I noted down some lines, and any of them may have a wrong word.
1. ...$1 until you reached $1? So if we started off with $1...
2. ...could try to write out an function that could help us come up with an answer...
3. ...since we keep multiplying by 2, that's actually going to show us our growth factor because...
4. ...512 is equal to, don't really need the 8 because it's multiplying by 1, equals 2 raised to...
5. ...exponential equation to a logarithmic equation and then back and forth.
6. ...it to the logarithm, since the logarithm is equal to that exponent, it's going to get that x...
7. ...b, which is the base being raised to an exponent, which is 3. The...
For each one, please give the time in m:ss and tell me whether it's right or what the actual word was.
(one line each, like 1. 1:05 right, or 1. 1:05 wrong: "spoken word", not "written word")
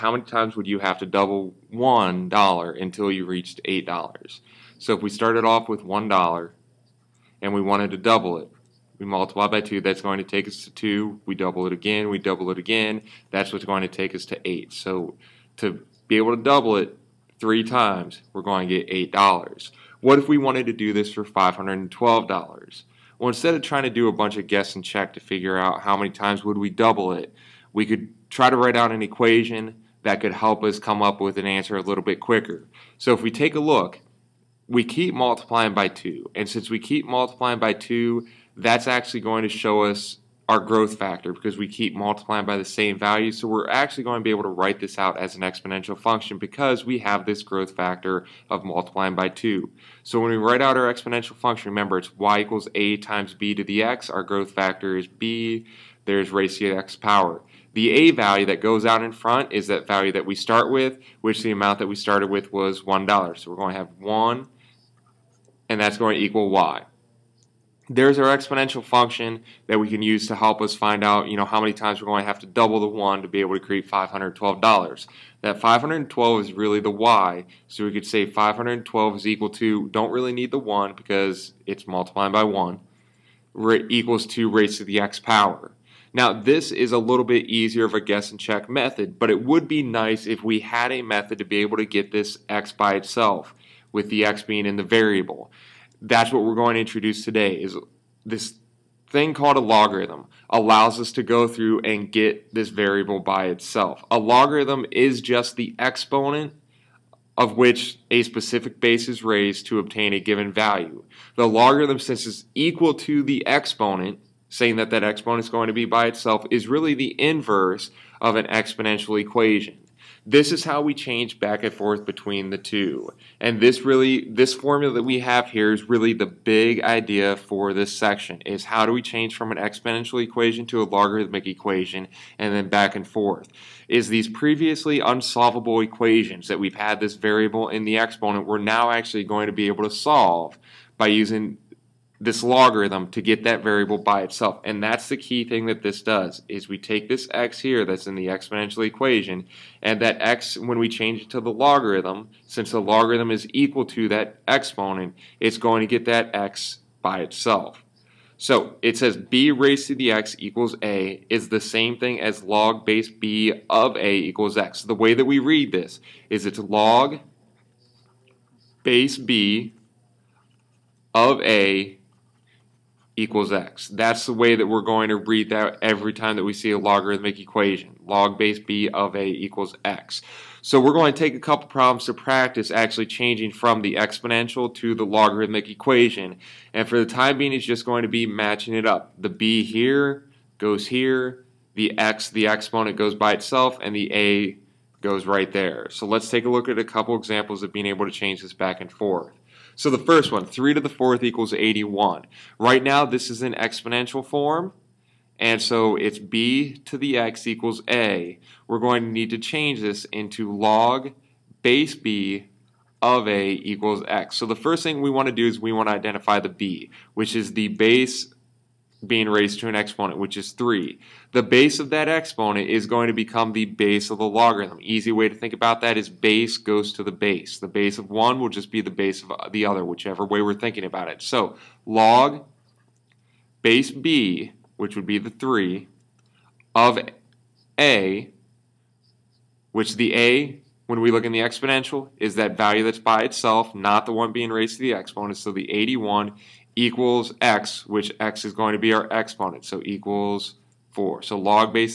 1. 0:01 wrong: "8", not "1"
2. 0:27 wrong: "equation", not "function"
3. 0:36 right
4. 1:18 wrong: "1", not "8"
5. 2:09 right
6. 2:31 right
7. 3:36 right.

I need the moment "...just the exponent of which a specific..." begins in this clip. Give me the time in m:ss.
1:45.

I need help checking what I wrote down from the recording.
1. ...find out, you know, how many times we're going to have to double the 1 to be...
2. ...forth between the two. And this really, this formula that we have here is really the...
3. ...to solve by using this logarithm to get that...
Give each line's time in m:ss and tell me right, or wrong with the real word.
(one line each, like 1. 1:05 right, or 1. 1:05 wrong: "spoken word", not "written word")
1. 1:10 right
2. 2:01 right
3. 2:19 right.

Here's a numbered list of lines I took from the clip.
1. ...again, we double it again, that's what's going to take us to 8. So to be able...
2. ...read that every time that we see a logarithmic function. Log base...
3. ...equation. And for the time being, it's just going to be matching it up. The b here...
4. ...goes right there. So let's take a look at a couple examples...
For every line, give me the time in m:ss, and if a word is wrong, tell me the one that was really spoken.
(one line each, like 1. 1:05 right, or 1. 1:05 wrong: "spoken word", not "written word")
1. 0:11 right
2. 2:55 wrong: "equation", not "function"
3. 3:05 right
4. 3:15 right.